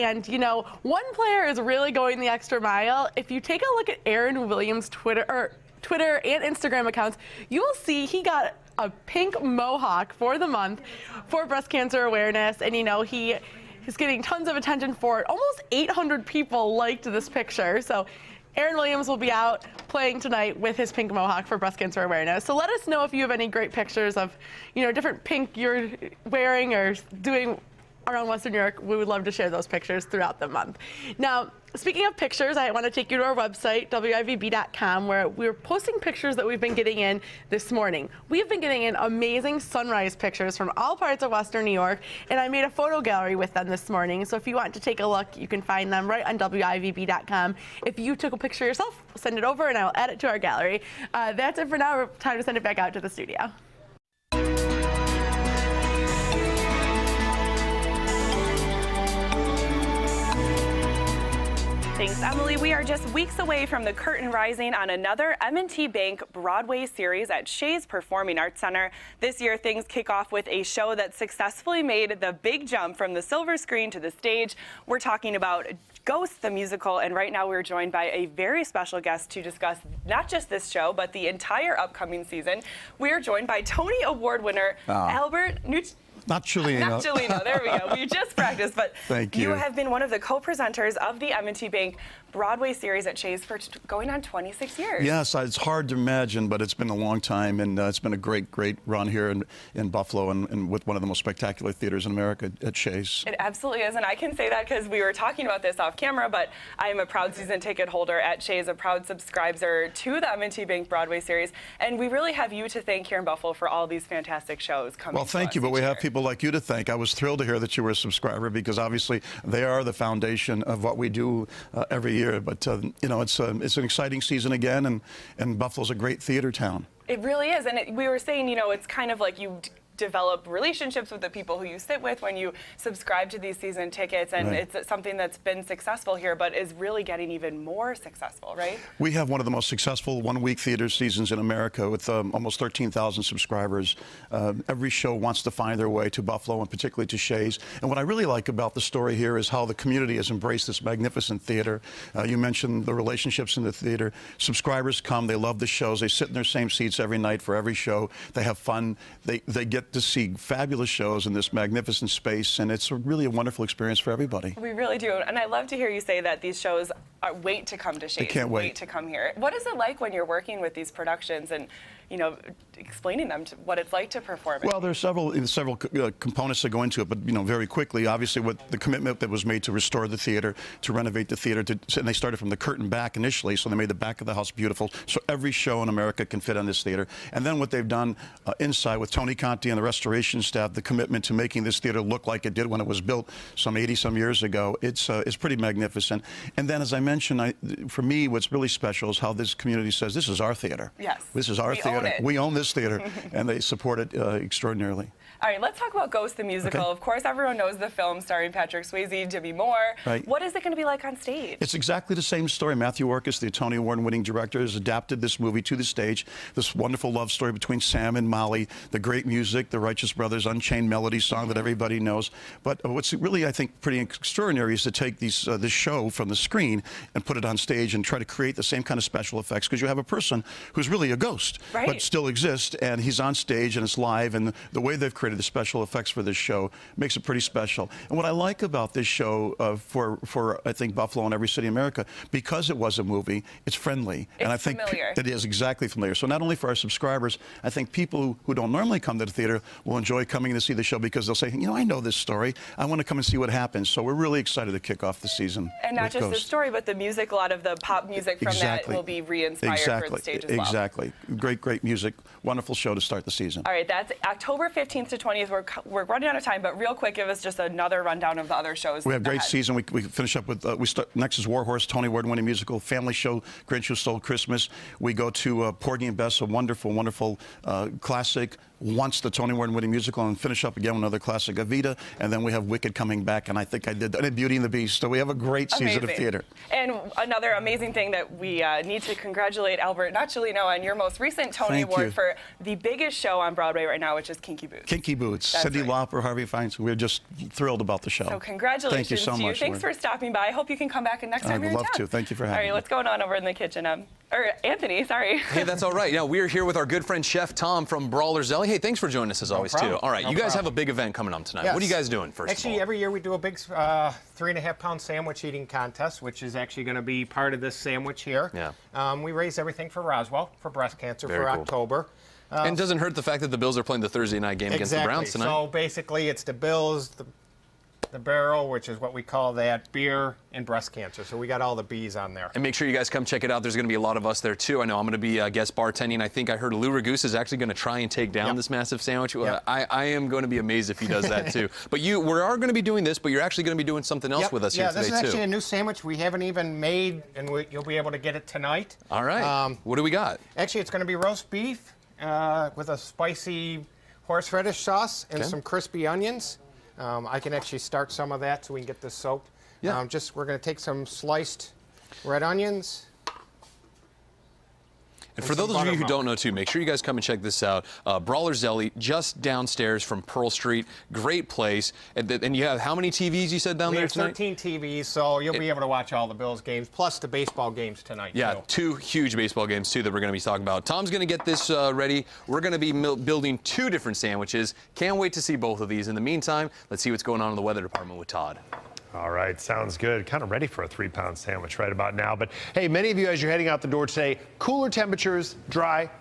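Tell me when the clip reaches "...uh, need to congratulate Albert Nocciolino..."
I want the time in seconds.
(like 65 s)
288 s.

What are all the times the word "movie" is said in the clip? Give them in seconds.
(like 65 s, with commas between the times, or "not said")
215 s, 243 s.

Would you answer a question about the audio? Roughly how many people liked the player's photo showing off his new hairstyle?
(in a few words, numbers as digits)
800.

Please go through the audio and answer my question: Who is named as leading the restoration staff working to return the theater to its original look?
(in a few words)
Tony Conti.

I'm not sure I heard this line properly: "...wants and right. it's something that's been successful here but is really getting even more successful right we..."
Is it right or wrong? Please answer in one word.
wrong.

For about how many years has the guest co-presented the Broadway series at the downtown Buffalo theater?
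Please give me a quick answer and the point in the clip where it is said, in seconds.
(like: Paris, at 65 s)
26 years, at 94 s.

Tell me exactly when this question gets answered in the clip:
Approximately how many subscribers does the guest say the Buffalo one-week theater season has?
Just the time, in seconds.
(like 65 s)
142 s.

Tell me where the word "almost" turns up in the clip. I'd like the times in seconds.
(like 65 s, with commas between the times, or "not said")
15 s, 142 s.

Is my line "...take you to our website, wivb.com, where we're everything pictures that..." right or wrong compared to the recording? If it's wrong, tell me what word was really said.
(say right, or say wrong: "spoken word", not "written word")
wrong: "posting", not "everything".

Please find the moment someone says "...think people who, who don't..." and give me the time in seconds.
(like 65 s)
247 s.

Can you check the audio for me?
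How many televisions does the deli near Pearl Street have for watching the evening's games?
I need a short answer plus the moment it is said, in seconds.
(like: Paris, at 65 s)
13, at 374 s.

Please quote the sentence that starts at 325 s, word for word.
So basically, it's the Bills, the the barrel, which is what we call that beer and breast cancer.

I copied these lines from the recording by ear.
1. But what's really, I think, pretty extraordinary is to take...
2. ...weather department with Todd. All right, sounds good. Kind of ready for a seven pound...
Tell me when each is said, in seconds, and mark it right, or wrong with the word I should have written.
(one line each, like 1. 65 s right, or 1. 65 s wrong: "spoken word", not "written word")
1. 222 s right
2. 387 s wrong: "three", not "seven".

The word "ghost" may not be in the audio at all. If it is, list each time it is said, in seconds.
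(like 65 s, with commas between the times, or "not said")
76 s, 206 s, 231 s, 256 s.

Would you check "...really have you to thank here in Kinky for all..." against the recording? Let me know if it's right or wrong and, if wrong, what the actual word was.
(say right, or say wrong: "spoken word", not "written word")
wrong: "Buffalo", not "Kinky".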